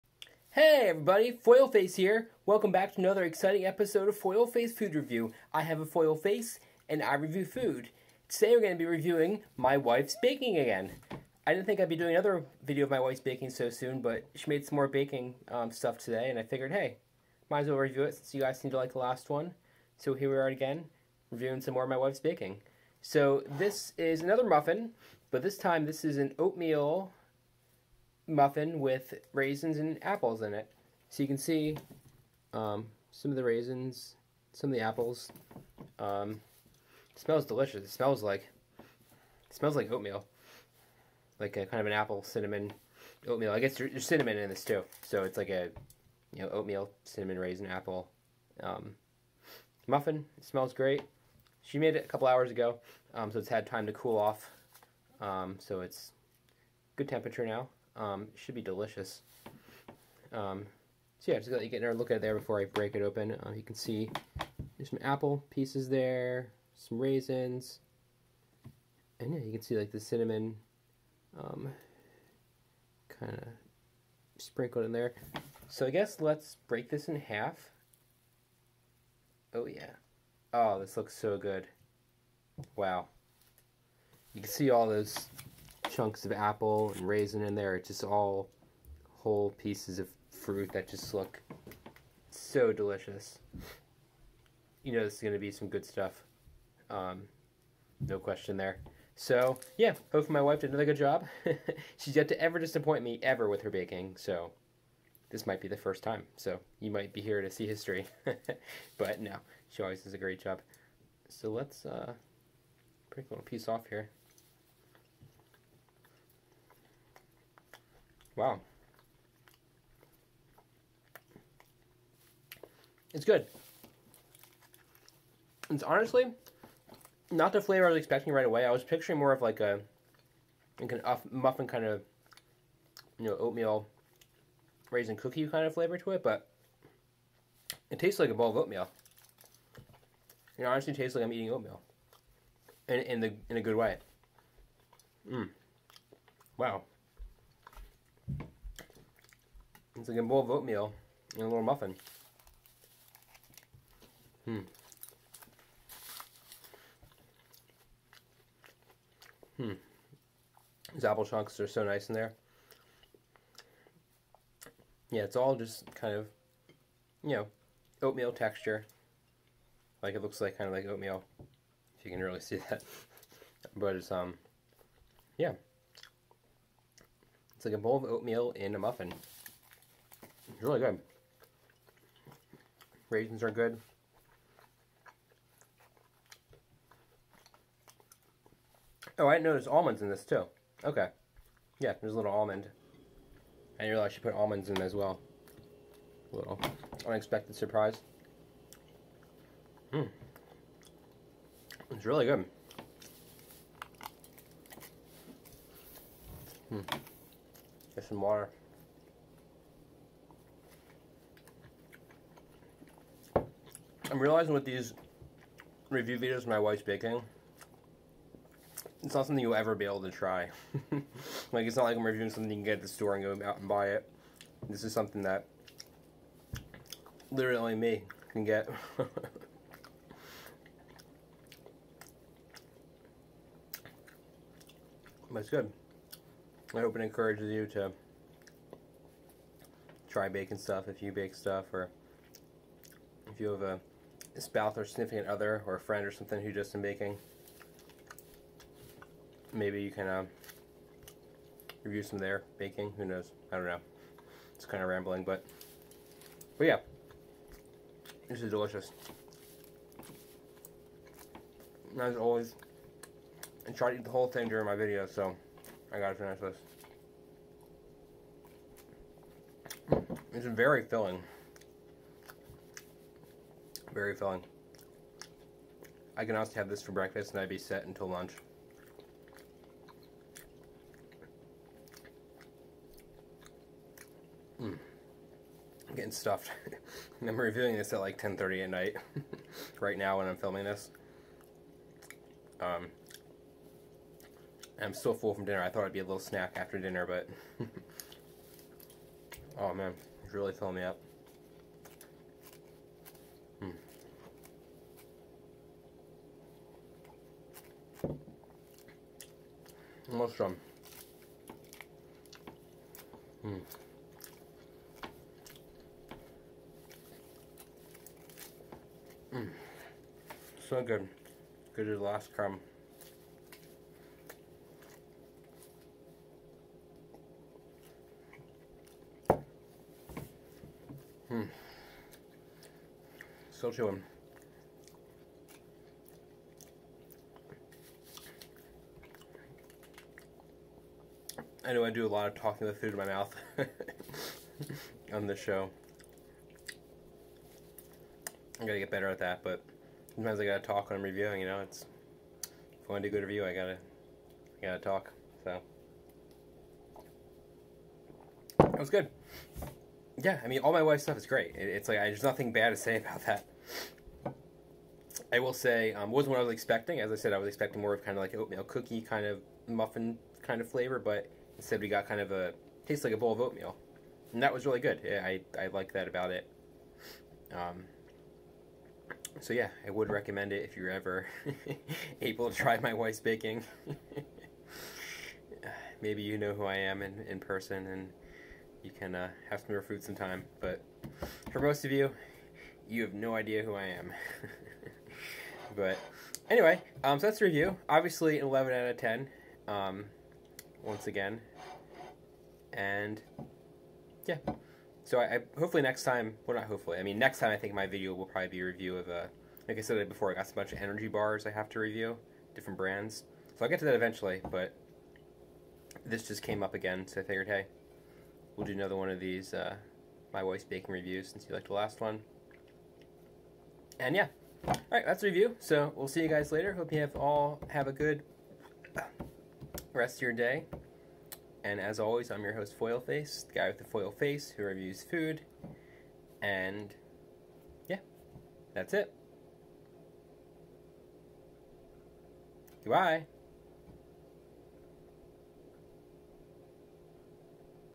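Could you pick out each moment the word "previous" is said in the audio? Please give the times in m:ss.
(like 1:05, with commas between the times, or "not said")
not said.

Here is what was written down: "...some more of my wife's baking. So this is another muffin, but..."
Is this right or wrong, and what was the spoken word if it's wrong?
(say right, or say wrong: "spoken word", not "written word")
right.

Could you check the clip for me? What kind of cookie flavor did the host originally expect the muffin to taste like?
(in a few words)
Oatmeal raisin.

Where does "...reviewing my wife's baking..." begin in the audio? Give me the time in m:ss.
0:08.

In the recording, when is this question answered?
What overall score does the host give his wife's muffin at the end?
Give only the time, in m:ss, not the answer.
6:38.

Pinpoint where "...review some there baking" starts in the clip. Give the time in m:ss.
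4:11.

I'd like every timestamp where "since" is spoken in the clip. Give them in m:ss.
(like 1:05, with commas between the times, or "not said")
0:18, 7:01.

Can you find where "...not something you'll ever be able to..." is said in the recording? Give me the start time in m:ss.
3:39.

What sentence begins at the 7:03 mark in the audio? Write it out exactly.
And yeah, all right, that's the review.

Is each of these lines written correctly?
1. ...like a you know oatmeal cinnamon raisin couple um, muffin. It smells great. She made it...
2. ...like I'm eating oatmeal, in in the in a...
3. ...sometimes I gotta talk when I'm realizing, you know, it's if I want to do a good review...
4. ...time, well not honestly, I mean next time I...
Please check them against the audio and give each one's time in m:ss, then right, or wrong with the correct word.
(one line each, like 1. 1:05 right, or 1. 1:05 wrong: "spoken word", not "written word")
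1. 0:45 wrong: "apple", not "couple"
2. 2:21 right
3. 5:50 wrong: "reviewing", not "realizing"
4. 6:46 wrong: "hopefully", not "honestly".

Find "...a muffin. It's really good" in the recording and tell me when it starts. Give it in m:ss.
2:58.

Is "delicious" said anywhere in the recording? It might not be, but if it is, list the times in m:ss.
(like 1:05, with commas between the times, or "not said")
0:37, 0:58, 1:32, 4:18.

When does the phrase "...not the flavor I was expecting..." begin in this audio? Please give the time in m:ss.
2:07.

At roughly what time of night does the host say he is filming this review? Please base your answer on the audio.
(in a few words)
10:30.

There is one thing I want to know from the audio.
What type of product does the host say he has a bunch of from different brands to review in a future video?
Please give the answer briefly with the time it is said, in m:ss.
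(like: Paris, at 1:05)
Energy bars, at 6:50.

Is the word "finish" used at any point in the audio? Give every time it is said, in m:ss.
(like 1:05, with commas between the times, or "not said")
4:26.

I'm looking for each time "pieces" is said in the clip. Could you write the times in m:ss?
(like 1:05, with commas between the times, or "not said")
1:05, 1:29, 1:53.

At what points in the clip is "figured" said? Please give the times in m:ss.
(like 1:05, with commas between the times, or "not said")
0:16, 6:57.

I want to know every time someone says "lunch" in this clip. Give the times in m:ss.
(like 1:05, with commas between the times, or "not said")
4:38.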